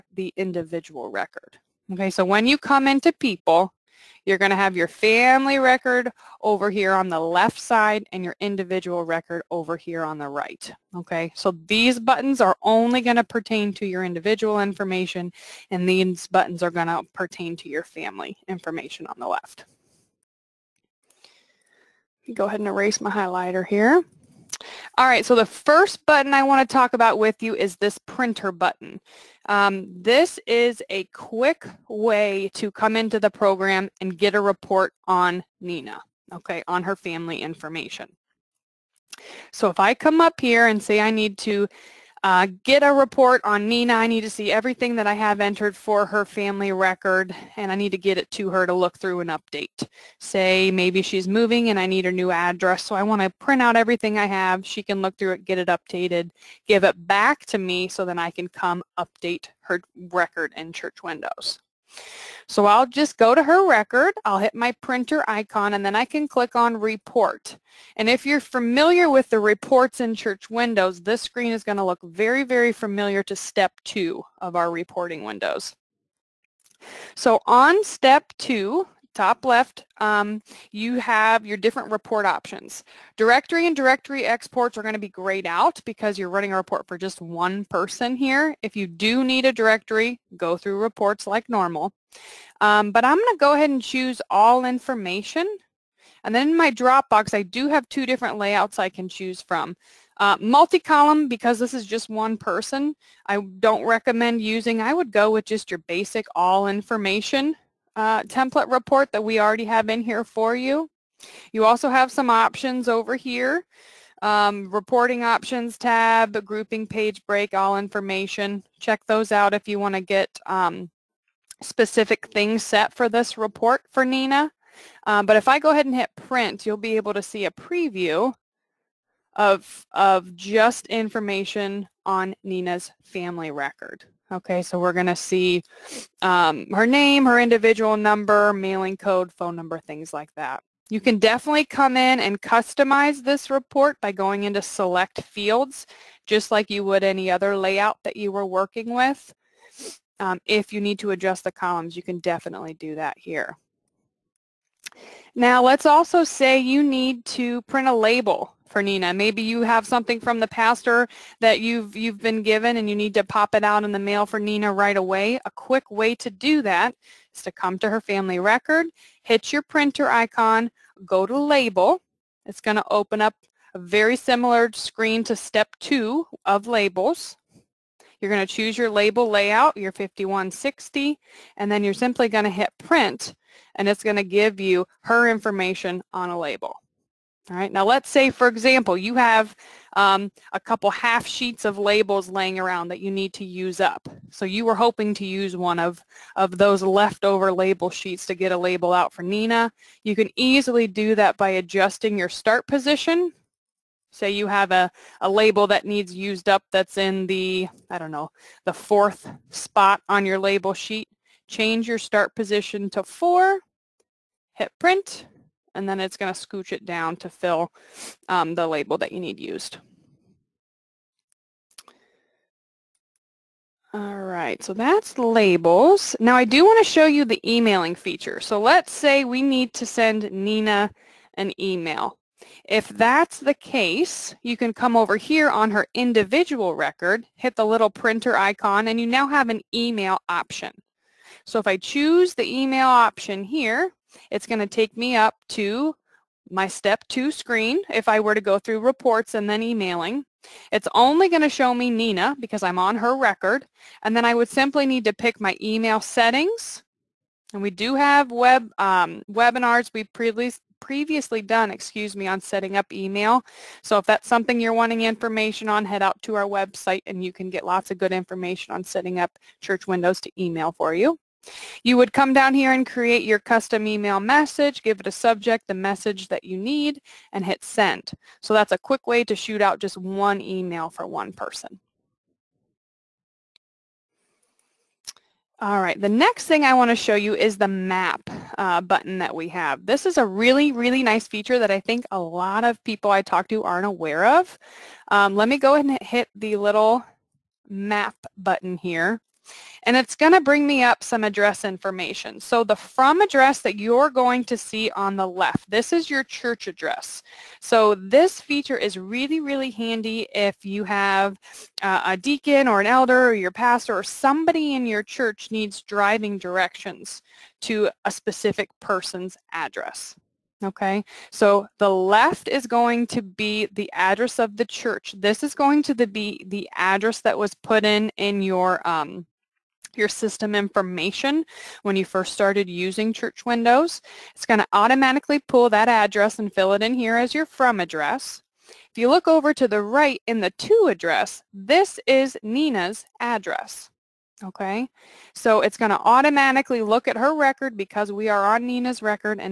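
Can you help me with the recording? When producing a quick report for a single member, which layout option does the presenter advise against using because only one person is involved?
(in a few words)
Multi-column.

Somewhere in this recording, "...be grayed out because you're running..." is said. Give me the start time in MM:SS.
01:24.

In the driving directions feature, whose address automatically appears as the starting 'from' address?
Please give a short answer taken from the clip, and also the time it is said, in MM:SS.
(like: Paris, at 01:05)
The church, at 05:06.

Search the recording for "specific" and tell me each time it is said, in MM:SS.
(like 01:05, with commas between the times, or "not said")
02:01, 05:18.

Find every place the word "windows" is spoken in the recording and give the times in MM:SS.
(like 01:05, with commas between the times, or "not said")
01:01, 01:10, 01:15, 04:29, 05:33.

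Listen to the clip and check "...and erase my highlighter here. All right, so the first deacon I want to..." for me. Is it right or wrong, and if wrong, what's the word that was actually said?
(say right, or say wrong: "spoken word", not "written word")
wrong: "button", not "deacon".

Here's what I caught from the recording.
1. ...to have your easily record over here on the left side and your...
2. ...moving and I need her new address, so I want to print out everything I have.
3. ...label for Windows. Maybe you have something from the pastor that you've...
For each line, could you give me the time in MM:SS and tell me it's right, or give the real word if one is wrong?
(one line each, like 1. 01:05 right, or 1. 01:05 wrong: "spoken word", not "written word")
1. 00:04 wrong: "family", not "easily"
2. 00:51 right
3. 02:37 wrong: "Nina", not "Windows".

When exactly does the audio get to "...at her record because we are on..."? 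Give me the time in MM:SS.
05:47.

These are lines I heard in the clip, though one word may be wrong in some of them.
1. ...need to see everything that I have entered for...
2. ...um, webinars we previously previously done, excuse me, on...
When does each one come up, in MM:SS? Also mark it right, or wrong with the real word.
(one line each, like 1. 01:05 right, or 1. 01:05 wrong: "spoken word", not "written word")
1. 00:44 right
2. 04:18 right.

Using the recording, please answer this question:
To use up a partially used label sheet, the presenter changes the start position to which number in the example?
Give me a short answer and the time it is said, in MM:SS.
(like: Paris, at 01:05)
4, at 03:33.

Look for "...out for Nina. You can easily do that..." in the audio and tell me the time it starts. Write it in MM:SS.
03:18.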